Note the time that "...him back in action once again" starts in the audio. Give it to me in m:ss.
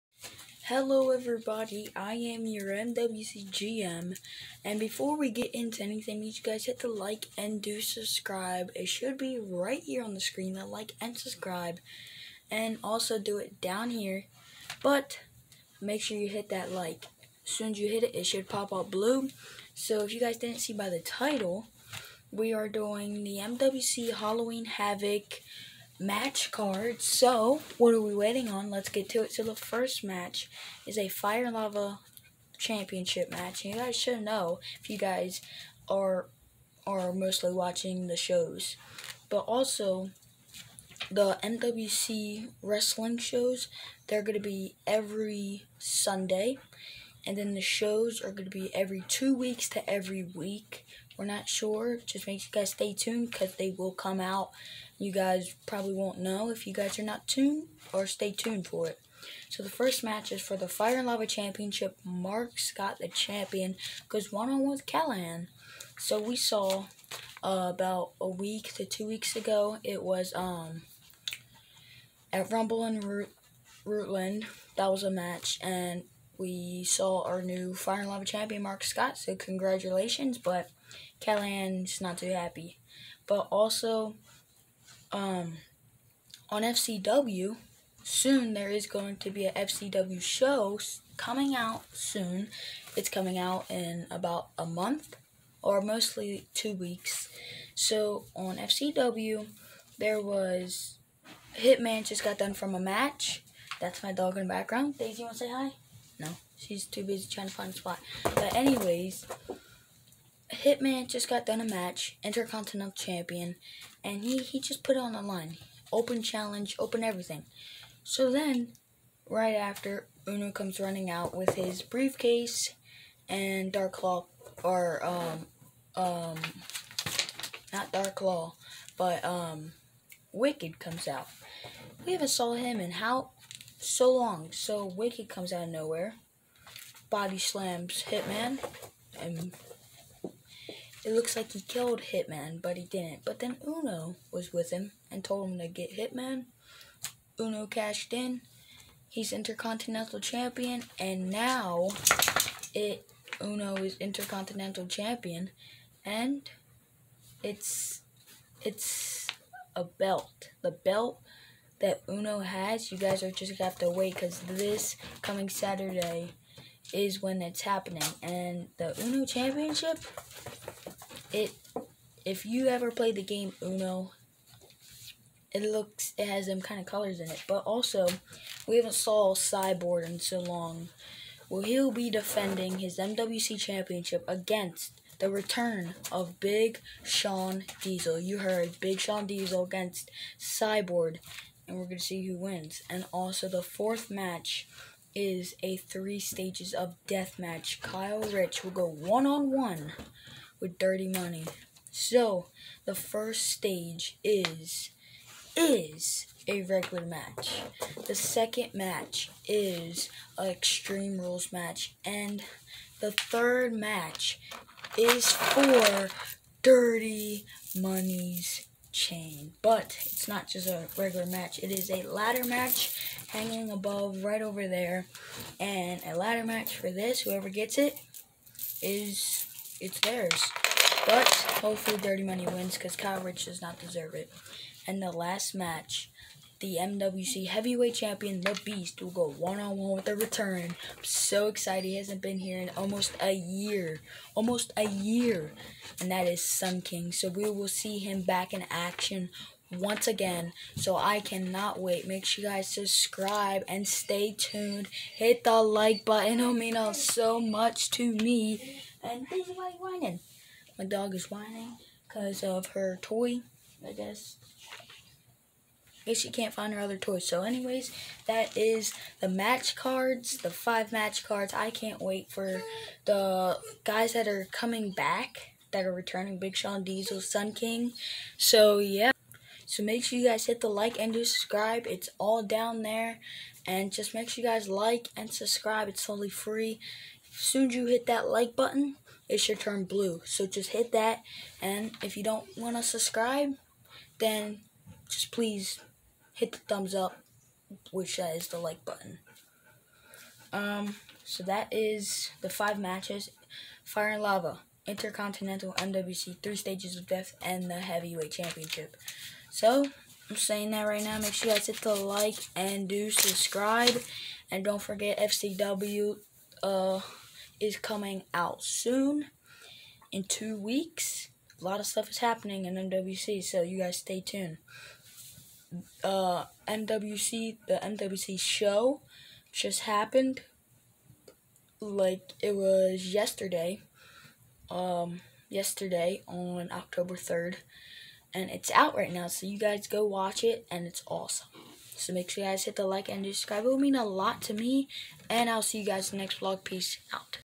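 4:07.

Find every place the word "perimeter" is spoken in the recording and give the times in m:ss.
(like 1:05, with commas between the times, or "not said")
not said.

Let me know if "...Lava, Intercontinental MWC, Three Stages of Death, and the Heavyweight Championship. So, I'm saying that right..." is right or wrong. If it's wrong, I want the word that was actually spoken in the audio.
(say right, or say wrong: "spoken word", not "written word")
right.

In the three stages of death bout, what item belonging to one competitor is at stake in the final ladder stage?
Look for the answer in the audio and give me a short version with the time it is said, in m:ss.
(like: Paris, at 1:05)
Dirty Money's chain, at 3:36.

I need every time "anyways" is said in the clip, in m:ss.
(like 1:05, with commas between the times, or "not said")
1:48, 4:27.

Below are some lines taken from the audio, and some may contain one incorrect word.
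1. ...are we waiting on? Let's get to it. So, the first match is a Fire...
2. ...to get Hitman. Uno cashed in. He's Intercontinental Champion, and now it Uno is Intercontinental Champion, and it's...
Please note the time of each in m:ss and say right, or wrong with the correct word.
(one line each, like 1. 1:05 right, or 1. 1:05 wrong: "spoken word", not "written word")
1. 0:27 right
2. 2:25 right.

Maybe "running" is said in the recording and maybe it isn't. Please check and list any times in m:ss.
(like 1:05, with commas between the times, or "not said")
2:00.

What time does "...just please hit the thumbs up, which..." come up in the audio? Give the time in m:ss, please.
4:55.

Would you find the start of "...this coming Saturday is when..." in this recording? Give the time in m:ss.
2:44.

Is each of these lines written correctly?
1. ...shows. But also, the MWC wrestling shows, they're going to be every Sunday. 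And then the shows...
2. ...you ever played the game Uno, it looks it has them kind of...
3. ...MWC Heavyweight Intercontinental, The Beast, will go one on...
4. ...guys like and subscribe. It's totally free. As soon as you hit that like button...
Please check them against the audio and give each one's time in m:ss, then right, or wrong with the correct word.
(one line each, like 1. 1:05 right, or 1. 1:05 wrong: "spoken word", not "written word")
1. 0:38 right
2. 2:52 right
3. 3:56 wrong: "Champion", not "Intercontinental"
4. 4:44 right.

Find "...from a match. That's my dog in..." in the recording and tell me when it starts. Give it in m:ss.
1:42.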